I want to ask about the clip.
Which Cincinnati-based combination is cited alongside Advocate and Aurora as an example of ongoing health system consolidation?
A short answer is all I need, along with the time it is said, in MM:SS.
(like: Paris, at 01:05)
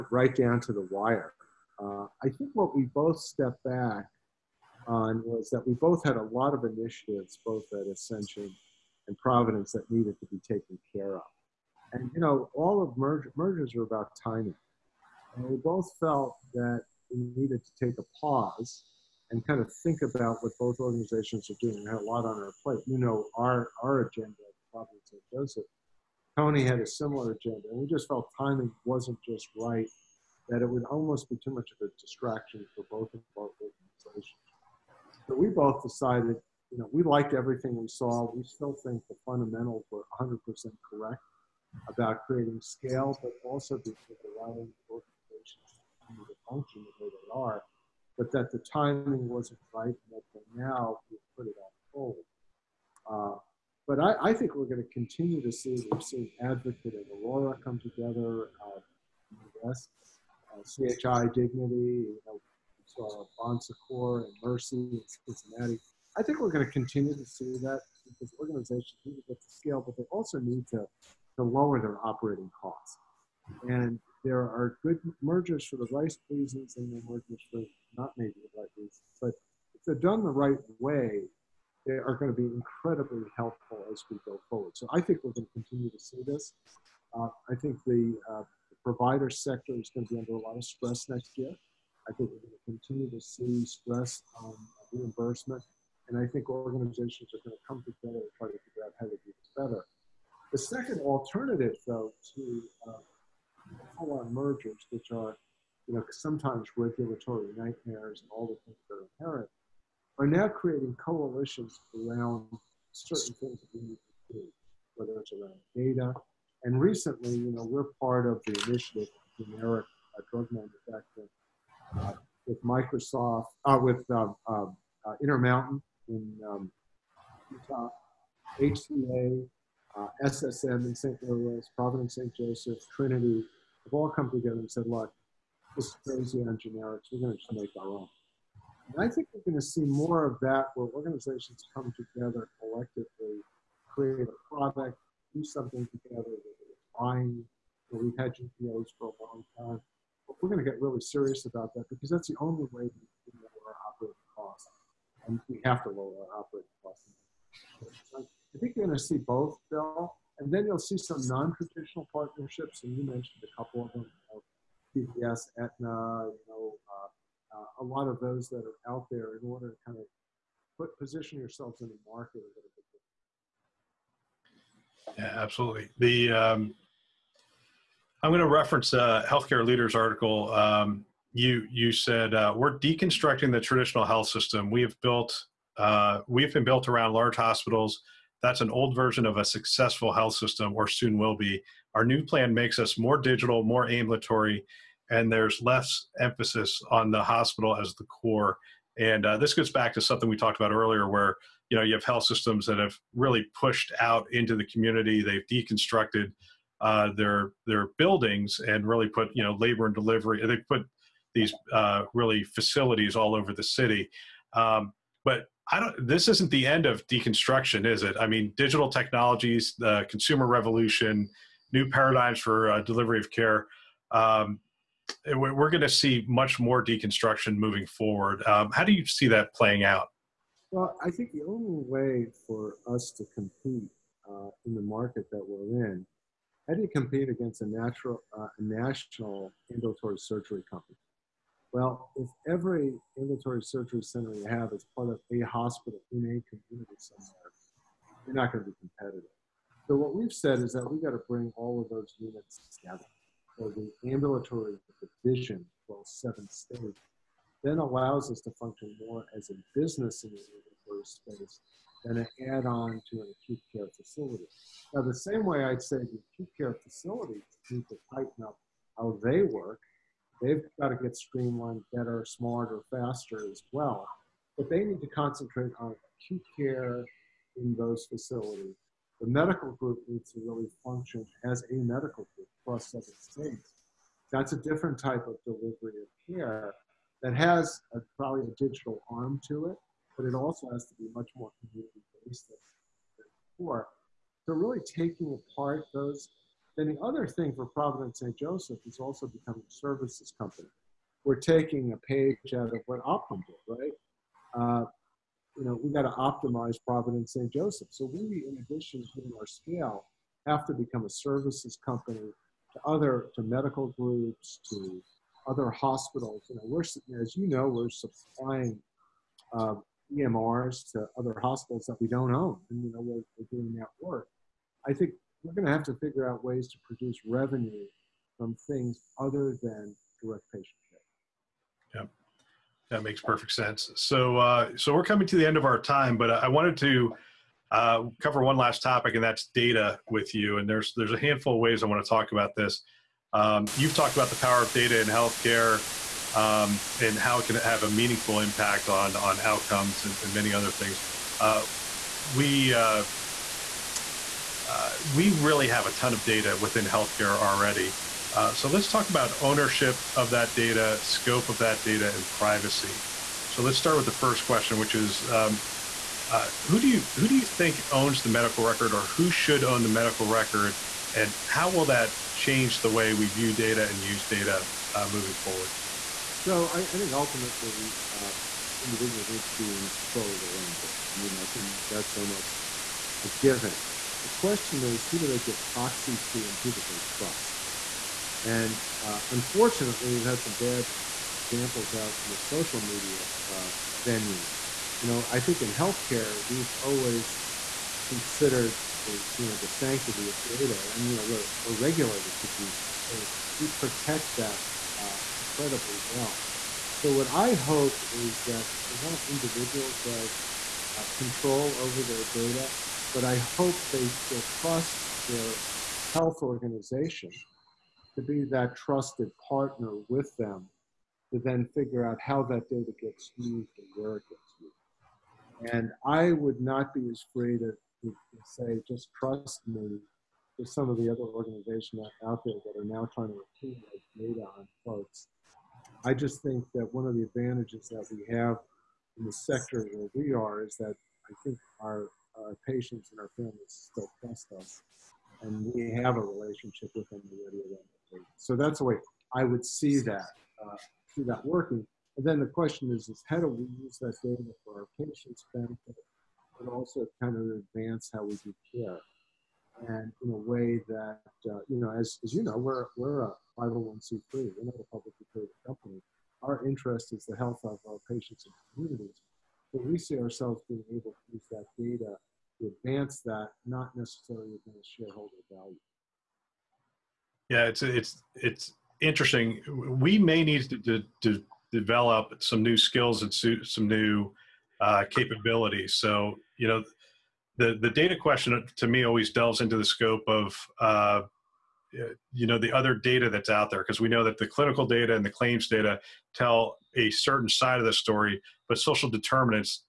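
Bon Secours and Mercy, at 01:03.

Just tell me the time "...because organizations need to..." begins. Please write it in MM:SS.
01:08.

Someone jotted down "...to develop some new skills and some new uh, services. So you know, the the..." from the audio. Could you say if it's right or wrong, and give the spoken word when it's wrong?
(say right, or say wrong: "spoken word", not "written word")
wrong: "capabilities", not "services".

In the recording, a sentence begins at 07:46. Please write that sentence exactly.
Our interest is the health of our patients and communities.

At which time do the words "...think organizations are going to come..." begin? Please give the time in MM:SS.
01:36.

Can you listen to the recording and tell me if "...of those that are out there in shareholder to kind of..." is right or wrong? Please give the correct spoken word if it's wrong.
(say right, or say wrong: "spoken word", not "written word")
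wrong: "order", not "shareholder".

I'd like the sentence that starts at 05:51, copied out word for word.
Uh, we uh, uh, we really have a ton of data within healthcare already.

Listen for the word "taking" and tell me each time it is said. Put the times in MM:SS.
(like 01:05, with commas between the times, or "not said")
04:54, 05:01.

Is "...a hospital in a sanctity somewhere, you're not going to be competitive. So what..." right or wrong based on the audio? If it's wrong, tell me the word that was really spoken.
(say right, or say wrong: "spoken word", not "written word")
wrong: "community", not "sanctity".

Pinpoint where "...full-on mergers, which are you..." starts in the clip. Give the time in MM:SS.
01:43.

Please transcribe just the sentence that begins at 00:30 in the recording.
That it would almost be too much of a distraction for both of our organizations.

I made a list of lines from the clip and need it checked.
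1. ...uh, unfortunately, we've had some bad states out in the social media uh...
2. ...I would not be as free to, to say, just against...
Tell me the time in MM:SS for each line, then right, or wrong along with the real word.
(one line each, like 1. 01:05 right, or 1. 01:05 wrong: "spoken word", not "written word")
1. 06:29 wrong: "examples", not "states"
2. 07:06 wrong: "trust", not "against".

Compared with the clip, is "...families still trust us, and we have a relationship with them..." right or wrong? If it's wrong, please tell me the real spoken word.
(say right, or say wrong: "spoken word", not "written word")
right.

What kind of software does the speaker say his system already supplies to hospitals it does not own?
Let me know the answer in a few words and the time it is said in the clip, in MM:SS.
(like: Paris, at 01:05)
EMRs, at 05:20.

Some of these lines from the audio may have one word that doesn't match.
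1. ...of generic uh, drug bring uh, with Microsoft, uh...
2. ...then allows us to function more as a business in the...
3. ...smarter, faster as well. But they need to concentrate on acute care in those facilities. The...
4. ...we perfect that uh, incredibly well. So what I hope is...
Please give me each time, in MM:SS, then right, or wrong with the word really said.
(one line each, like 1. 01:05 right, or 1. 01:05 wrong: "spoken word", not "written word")
1. 01:59 wrong: "manufacturing", not "bring"
2. 04:17 right
3. 04:32 right
4. 06:43 wrong: "protect", not "perfect".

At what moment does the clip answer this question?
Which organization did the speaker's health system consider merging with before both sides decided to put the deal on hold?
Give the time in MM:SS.
00:07.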